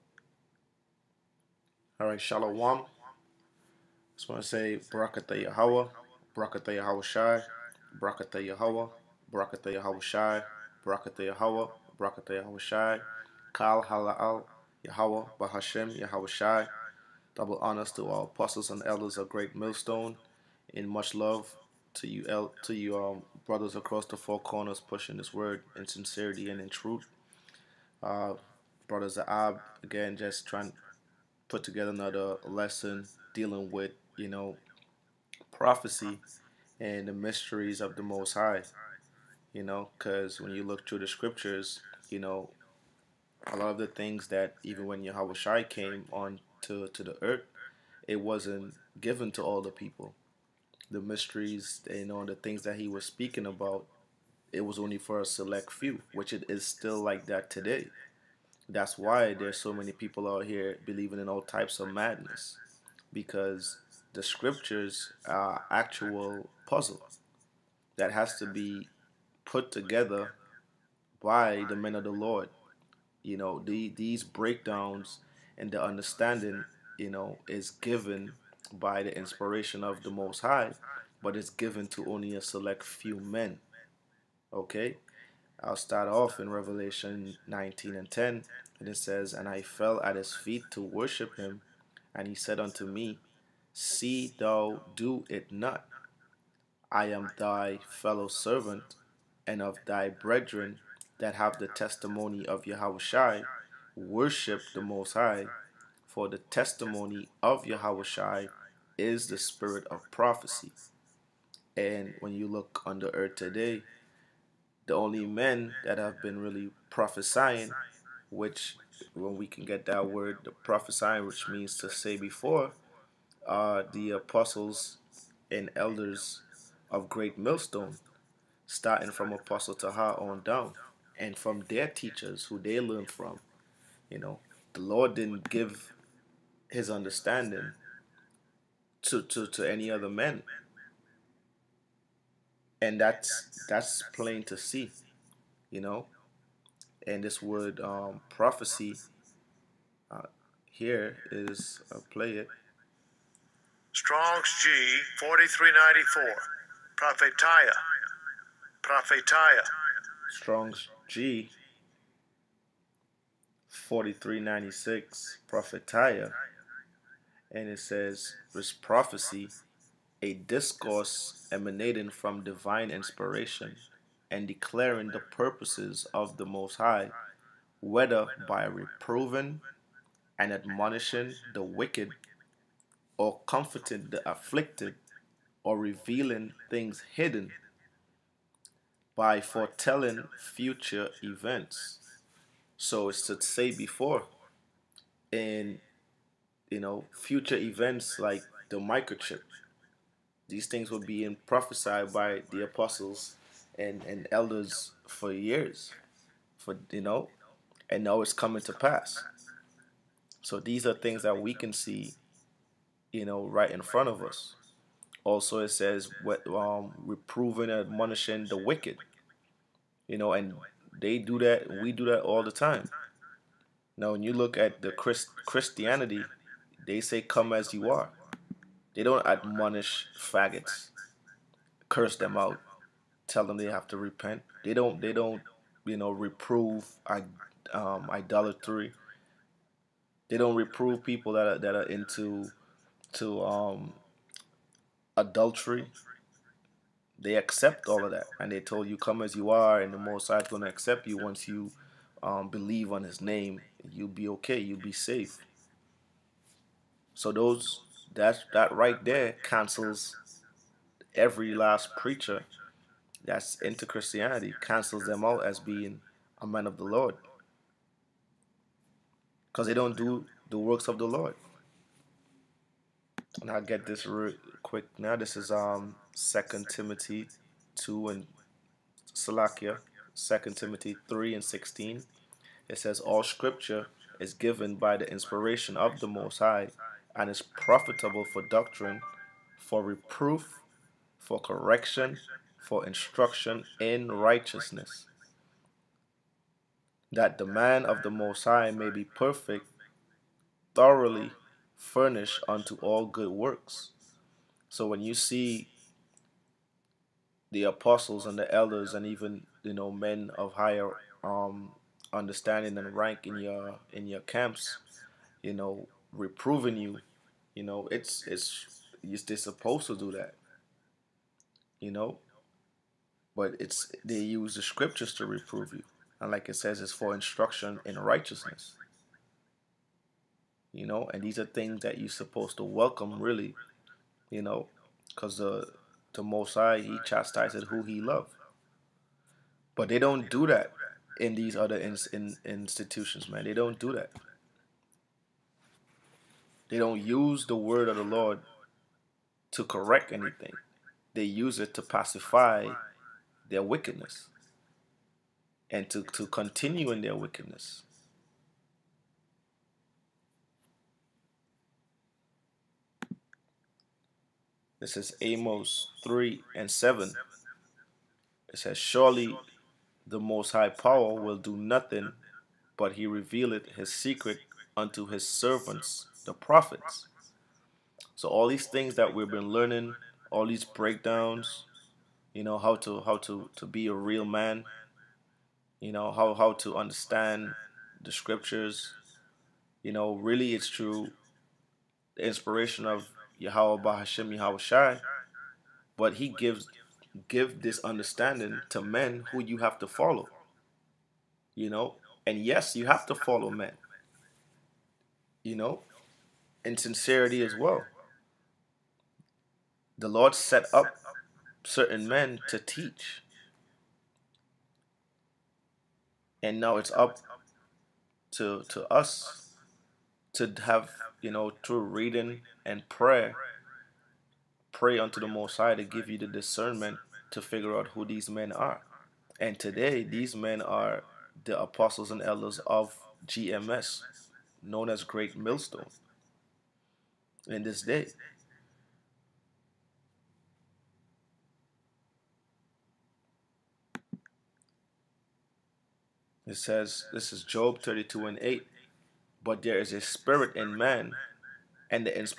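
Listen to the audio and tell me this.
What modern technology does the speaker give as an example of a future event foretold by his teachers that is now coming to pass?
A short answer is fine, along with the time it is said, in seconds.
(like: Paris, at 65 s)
Microchip, at 198 s.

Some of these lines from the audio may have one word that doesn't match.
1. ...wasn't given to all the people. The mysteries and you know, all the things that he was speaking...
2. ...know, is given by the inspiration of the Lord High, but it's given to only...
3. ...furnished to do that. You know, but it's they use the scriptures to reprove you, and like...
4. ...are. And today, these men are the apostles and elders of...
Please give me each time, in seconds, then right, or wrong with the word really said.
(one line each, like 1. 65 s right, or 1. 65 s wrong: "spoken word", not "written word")
1. 48 s right
2. 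77 s wrong: "Most", not "Lord"
3. 319 s wrong: "supposed", not "furnished"
4. 428 s right.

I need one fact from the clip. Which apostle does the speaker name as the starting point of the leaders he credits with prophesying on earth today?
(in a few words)
Apostle Taha.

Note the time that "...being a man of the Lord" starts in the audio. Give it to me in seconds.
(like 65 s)
265 s.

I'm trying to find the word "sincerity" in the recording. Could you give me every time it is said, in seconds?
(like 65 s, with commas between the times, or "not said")
25 s, 406 s.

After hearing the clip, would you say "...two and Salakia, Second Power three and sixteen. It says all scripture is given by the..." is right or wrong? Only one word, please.
wrong.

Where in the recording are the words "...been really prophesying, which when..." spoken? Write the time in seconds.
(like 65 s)
116 s.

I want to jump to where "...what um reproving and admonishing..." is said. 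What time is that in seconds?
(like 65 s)
216 s.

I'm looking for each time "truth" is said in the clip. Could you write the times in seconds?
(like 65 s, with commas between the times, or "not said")
26 s.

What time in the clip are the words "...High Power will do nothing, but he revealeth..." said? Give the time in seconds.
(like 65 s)
370 s.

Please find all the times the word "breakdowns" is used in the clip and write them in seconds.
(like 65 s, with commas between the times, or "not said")
74 s, 380 s.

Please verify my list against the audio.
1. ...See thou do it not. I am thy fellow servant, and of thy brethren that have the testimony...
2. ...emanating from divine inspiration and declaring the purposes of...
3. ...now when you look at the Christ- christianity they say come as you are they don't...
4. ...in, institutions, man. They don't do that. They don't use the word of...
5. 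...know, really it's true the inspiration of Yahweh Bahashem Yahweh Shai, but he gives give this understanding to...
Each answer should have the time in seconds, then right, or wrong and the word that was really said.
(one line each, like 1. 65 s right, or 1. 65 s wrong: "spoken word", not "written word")
1. 93 s right
2. 171 s right
3. 223 s right
4. 342 s right
5. 389 s right.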